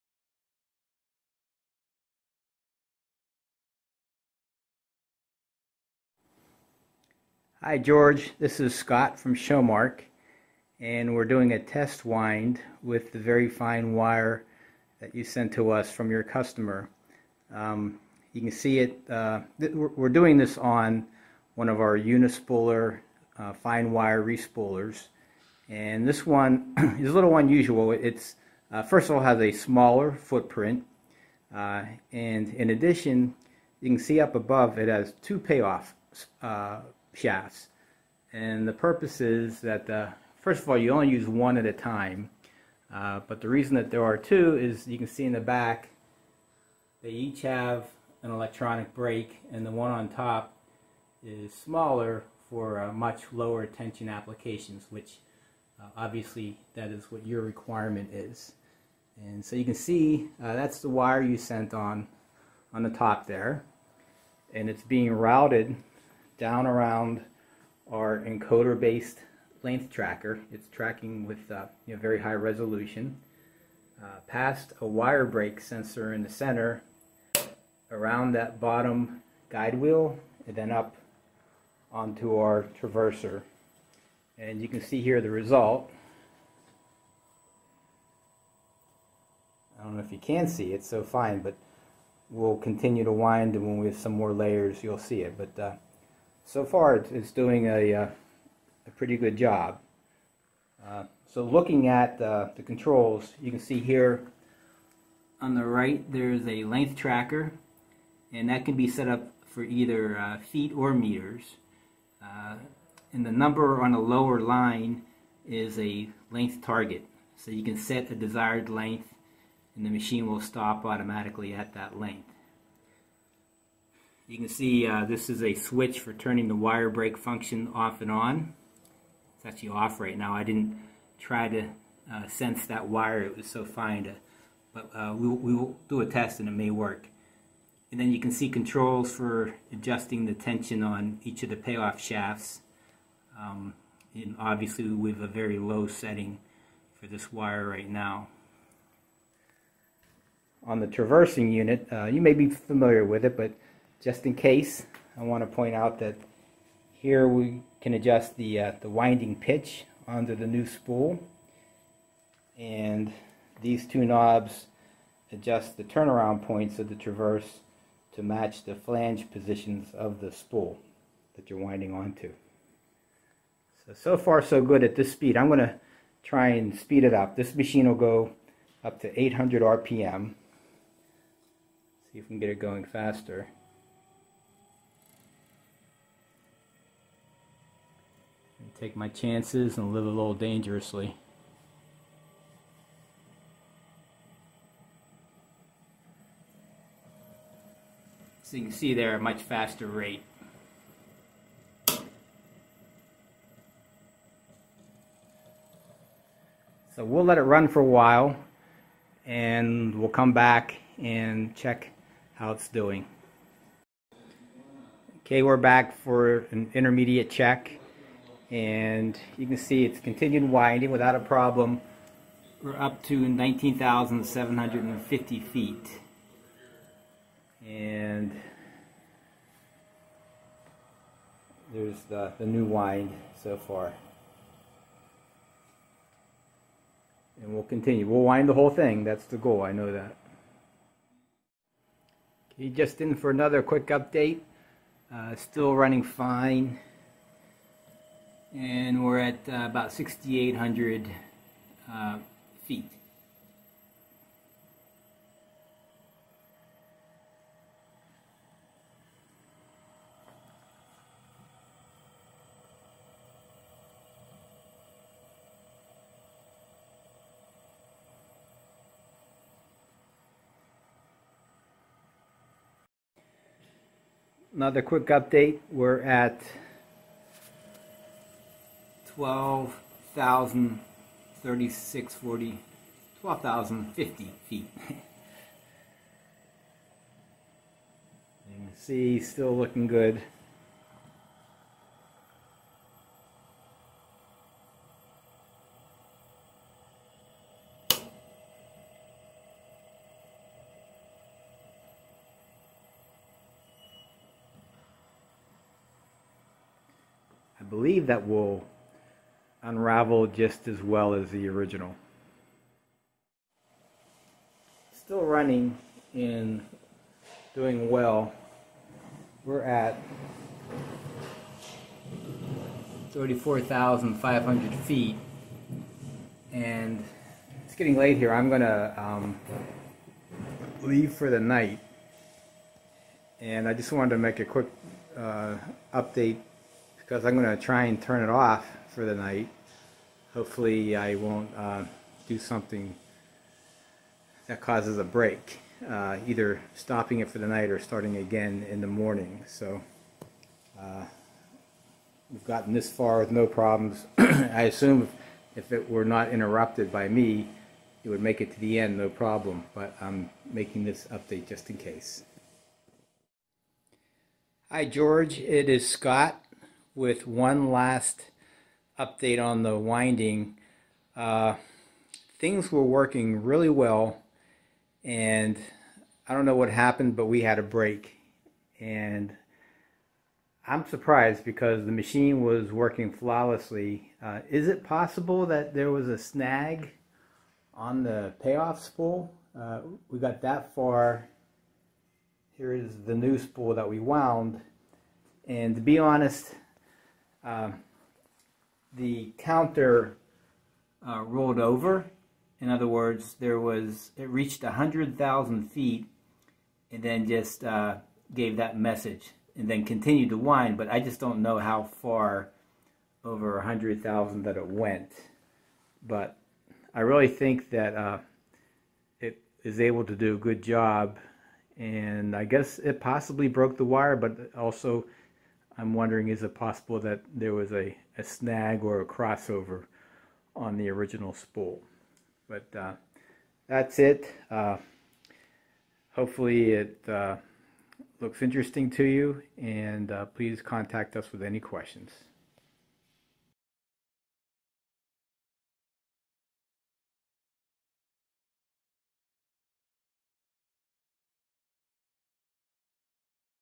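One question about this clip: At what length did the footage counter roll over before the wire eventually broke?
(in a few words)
100,000 feet.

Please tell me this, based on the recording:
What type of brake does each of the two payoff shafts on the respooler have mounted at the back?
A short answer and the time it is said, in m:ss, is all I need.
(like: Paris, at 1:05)
electronic brake, at 0:48.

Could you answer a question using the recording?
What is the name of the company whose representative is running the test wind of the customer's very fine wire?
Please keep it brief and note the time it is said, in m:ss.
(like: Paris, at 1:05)
Showmark, at 0:09.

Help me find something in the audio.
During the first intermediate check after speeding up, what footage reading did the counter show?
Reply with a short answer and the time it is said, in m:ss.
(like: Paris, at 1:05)
19,750 feet, at 3:43.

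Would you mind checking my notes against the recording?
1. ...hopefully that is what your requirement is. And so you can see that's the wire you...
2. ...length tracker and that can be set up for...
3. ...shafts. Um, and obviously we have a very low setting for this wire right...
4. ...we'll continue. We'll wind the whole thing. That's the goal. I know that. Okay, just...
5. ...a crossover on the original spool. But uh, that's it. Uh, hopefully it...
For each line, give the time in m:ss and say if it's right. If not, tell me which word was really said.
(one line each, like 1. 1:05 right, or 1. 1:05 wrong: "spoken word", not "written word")
1. 0:55 wrong: "obviously", not "hopefully"
2. 1:46 right
3. 2:21 right
4. 3:57 right
5. 7:09 right.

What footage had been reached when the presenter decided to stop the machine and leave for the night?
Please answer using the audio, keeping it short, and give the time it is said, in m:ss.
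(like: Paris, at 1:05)
34,500 feet, at 5:23.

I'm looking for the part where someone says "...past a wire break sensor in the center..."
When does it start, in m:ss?
1:14.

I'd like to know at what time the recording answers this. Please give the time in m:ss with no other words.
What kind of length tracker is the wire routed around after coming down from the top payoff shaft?
1:08.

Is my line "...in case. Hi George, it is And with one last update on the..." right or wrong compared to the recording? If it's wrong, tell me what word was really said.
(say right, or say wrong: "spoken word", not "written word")
wrong: "Scott", not "And".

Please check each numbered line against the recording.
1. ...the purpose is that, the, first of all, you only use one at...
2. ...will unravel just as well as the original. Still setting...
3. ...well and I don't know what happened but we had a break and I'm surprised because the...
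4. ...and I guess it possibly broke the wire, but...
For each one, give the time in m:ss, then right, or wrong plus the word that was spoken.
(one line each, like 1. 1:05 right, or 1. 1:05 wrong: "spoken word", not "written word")
1. 0:38 right
2. 5:08 wrong: "running", not "setting"
3. 6:13 right
4. 7:01 right.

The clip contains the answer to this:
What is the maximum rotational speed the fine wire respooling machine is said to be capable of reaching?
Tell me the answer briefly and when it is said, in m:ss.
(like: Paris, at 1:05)
800 RPM, at 2:59.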